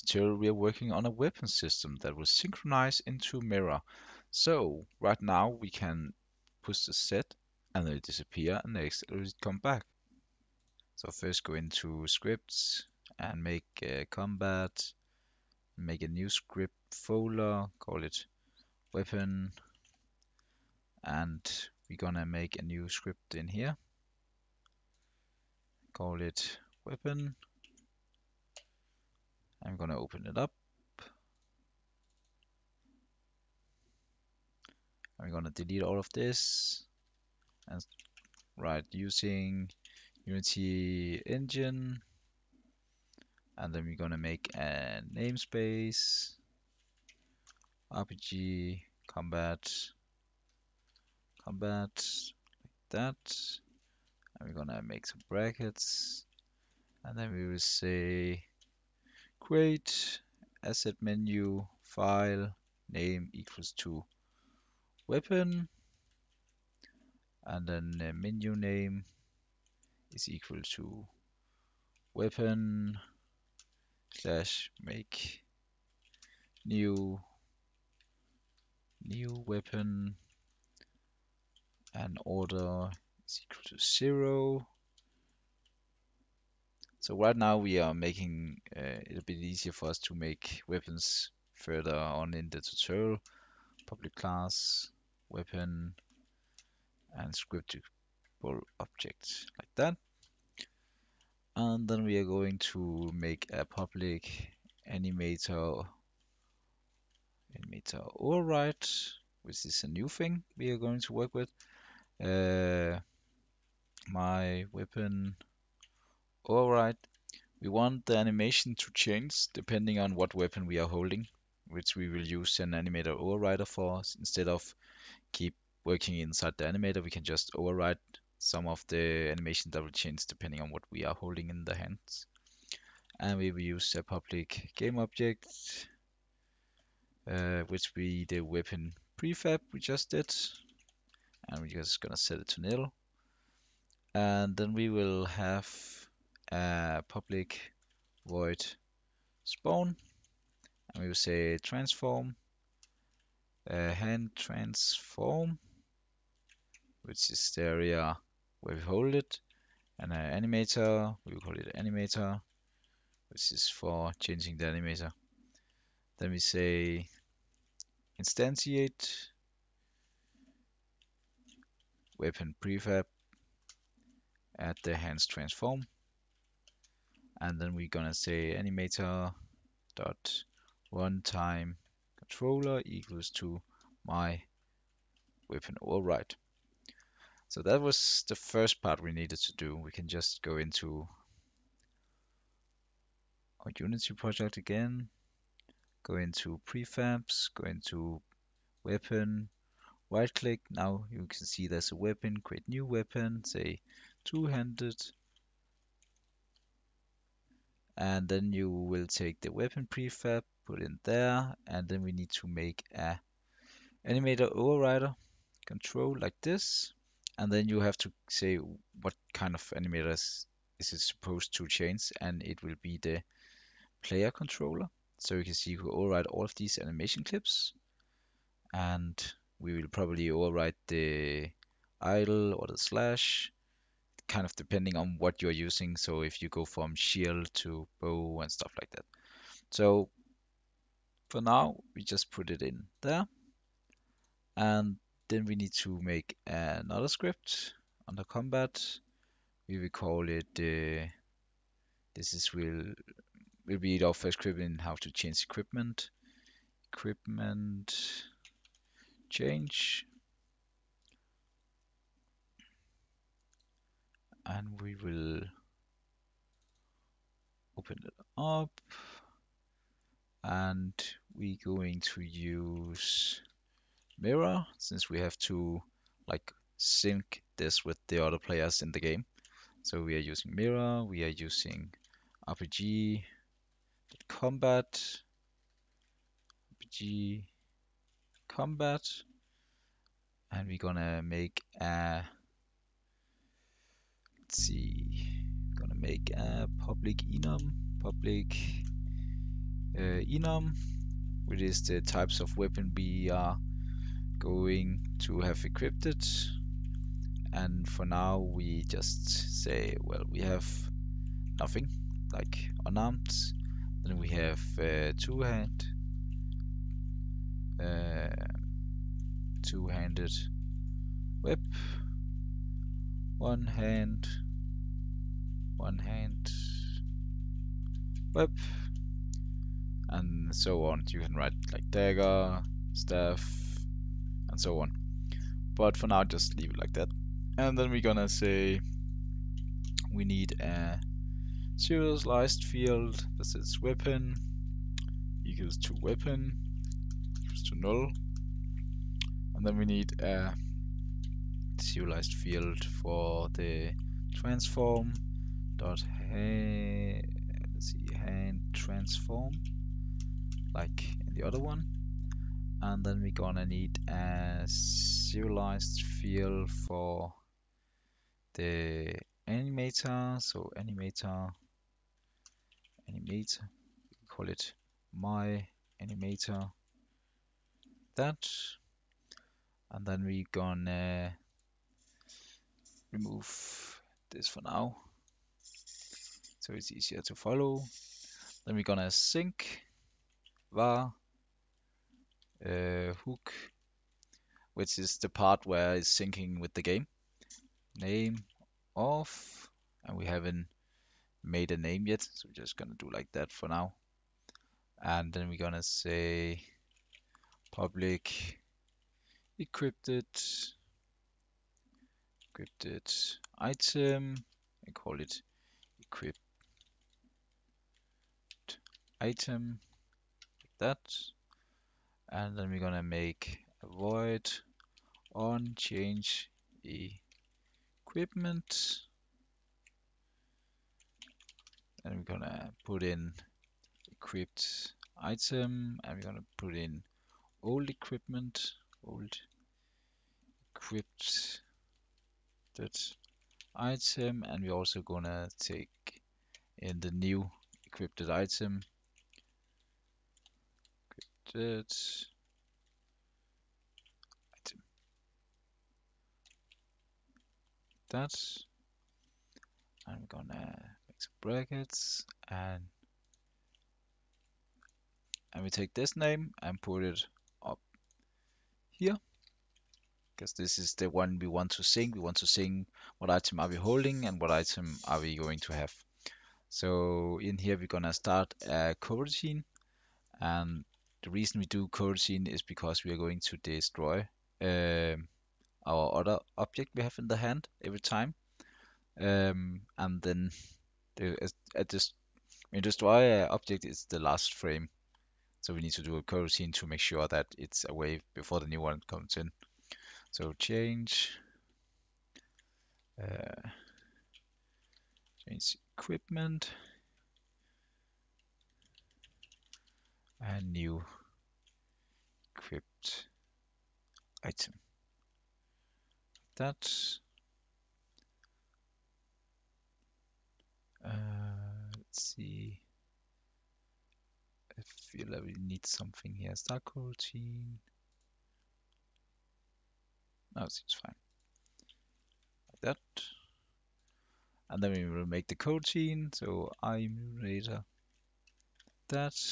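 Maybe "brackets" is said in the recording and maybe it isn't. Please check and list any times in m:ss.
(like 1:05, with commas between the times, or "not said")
0:55, 7:41.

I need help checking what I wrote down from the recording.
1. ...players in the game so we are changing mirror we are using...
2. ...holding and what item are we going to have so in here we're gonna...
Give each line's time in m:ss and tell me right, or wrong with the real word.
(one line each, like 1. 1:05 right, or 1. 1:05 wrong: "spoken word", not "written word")
1. 4:38 wrong: "using", not "changing"
2. 7:53 right.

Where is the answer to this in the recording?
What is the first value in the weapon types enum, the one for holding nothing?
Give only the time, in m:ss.
5:12.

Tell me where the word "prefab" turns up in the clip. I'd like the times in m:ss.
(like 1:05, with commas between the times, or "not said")
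2:19, 2:52, 3:16, 3:29.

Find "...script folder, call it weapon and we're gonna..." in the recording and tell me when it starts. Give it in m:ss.
0:16.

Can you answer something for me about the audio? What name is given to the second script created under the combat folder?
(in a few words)
Equipment change.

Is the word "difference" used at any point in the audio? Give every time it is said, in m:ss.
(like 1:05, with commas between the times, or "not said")
not said.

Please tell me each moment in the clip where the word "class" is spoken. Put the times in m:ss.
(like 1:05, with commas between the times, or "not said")
1:34.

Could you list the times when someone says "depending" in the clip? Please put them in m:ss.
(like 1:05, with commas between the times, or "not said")
1:59, 2:10, 3:54.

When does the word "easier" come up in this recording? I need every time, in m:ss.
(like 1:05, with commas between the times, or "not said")
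1:29, 6:26.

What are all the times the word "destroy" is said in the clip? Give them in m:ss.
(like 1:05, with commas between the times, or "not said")
8:03, 8:12.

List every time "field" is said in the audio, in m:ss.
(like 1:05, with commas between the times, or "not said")
5:42, 5:52, 6:06.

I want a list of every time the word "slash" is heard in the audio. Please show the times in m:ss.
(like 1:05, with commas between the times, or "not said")
1:14, 3:52.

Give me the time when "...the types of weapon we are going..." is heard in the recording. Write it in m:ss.
5:01.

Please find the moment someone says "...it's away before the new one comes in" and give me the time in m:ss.
8:17.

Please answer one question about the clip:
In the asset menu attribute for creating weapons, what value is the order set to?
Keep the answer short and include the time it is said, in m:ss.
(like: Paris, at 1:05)
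0, at 1:23.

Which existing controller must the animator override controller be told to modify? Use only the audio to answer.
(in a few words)
player controller.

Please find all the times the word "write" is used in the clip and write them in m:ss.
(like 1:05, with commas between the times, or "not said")
0:38, 5:31.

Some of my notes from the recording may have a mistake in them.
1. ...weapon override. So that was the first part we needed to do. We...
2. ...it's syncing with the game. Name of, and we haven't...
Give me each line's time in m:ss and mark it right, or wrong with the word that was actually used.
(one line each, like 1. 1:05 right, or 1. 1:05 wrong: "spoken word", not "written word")
1. 3:05 right
2. 6:35 right.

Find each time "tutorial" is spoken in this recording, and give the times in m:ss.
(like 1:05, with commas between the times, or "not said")
0:00, 1:32.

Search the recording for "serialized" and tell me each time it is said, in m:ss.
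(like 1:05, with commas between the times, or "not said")
5:41, 5:51, 6:04.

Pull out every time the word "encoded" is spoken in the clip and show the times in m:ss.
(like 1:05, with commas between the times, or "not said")
not said.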